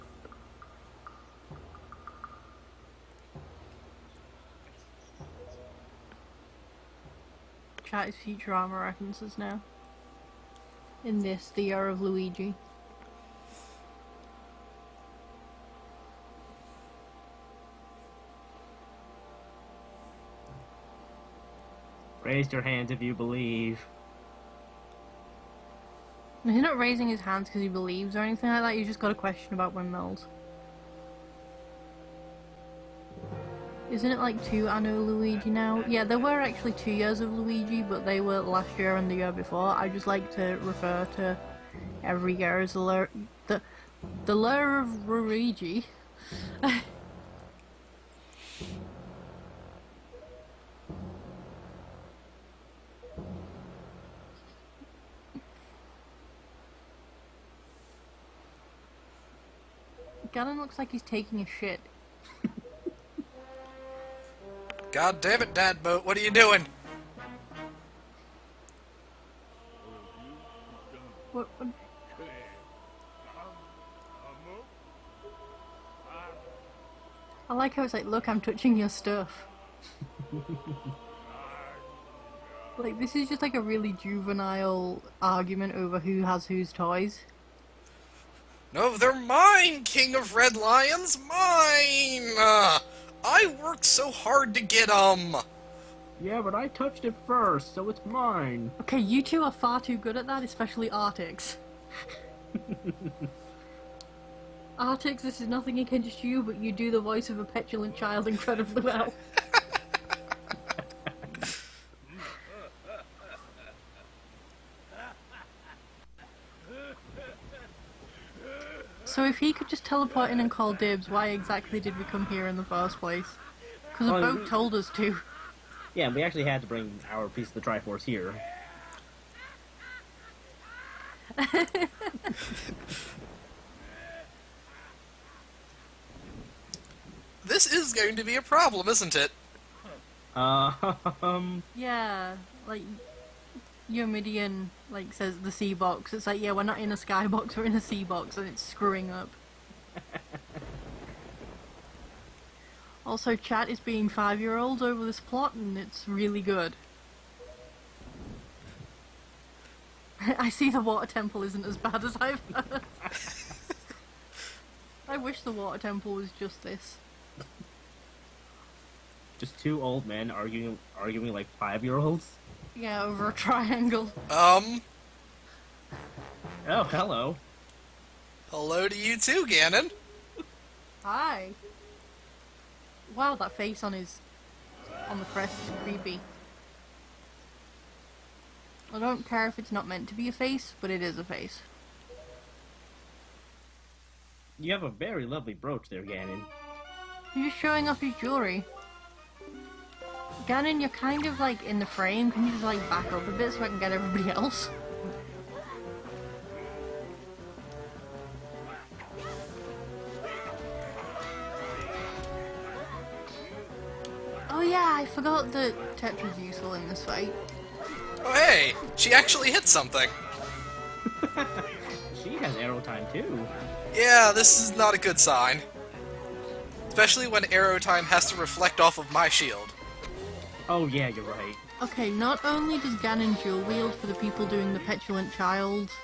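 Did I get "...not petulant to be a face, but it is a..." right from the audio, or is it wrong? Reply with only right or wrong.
wrong.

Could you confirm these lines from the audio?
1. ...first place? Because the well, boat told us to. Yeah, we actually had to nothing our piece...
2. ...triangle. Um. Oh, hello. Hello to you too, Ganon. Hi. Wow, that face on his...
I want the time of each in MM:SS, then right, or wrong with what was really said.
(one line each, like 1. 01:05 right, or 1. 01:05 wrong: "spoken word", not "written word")
1. 02:02 wrong: "bring", not "nothing"
2. 02:53 right.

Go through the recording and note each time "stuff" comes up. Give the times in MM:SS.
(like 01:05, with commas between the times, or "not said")
01:18.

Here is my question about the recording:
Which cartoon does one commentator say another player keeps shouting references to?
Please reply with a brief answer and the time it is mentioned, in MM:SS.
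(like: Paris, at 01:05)
Futurama, at 00:08.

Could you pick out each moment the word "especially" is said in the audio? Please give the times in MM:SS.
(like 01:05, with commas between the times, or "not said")
01:40, 03:46.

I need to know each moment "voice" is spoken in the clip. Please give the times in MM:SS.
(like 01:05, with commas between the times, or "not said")
01:47.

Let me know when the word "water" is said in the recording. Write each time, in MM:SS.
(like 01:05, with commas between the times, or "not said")
02:40, 02:45.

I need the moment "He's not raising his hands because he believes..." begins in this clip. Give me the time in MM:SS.
00:26.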